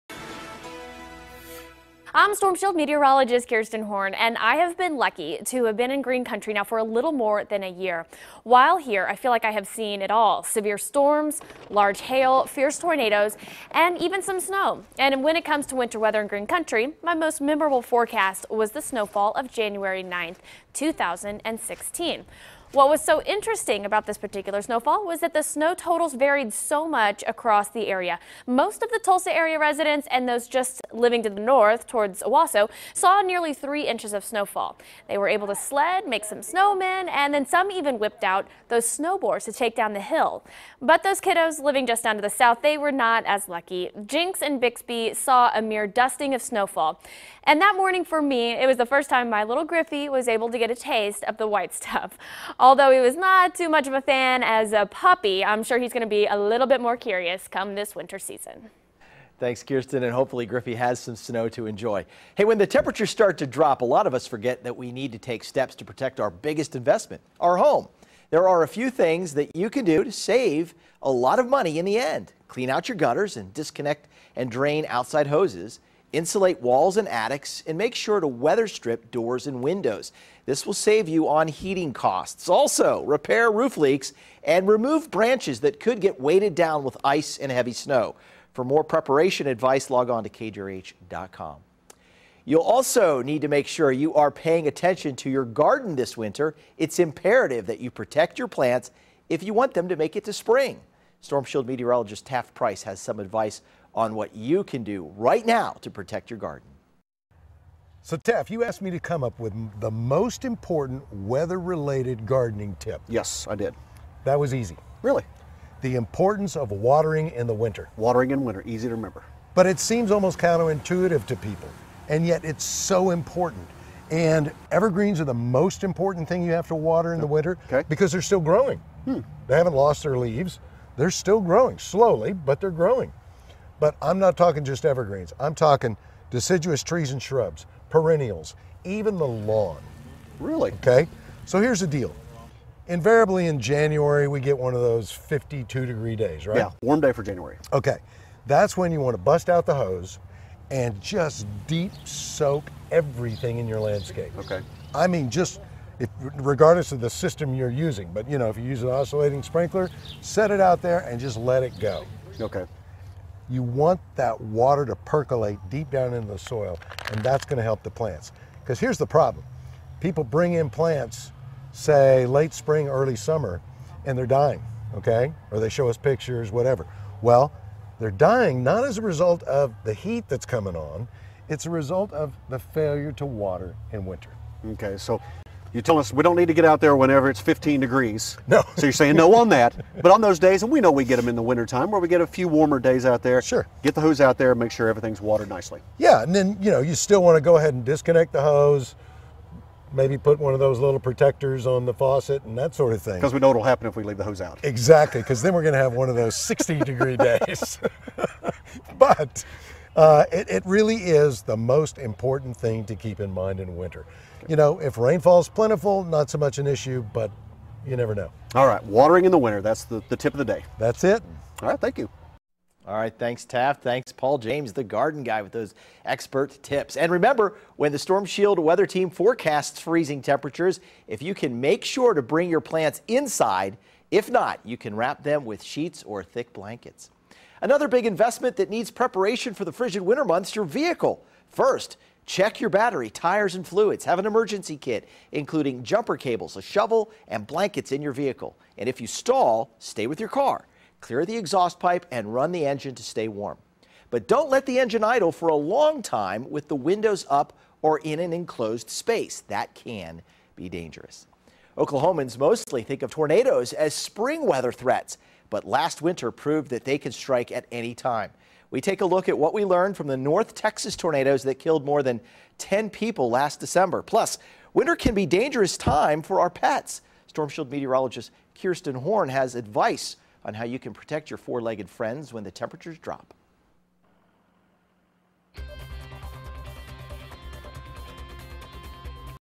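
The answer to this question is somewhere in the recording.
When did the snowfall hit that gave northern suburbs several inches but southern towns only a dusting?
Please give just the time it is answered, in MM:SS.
00:19.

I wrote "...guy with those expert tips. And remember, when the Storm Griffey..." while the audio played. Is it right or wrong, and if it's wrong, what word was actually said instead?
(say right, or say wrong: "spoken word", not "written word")
wrong: "Shield", not "Griffey".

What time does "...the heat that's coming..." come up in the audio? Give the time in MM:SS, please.
02:59.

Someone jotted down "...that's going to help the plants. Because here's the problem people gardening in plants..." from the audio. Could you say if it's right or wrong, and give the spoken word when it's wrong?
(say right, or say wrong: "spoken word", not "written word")
wrong: "bring", not "gardening".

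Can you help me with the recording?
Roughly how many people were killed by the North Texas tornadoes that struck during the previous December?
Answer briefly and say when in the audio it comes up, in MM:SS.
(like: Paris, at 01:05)
More than 10, at 04:31.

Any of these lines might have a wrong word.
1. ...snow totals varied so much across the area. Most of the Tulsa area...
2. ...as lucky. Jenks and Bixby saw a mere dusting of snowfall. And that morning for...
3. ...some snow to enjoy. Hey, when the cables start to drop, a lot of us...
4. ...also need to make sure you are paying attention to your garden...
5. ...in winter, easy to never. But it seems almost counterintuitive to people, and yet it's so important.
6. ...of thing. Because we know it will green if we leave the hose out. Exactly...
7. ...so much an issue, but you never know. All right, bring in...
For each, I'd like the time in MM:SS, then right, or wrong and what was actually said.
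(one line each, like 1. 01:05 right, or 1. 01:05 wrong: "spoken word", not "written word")
1. 00:25 right
2. 00:43 right
3. 01:00 wrong: "temperatures", not "cables"
4. 01:32 right
5. 01:58 wrong: "remember", not "never"
6. 03:22 wrong: "happen", not "green"
7. 03:36 wrong: "watering", not "bring".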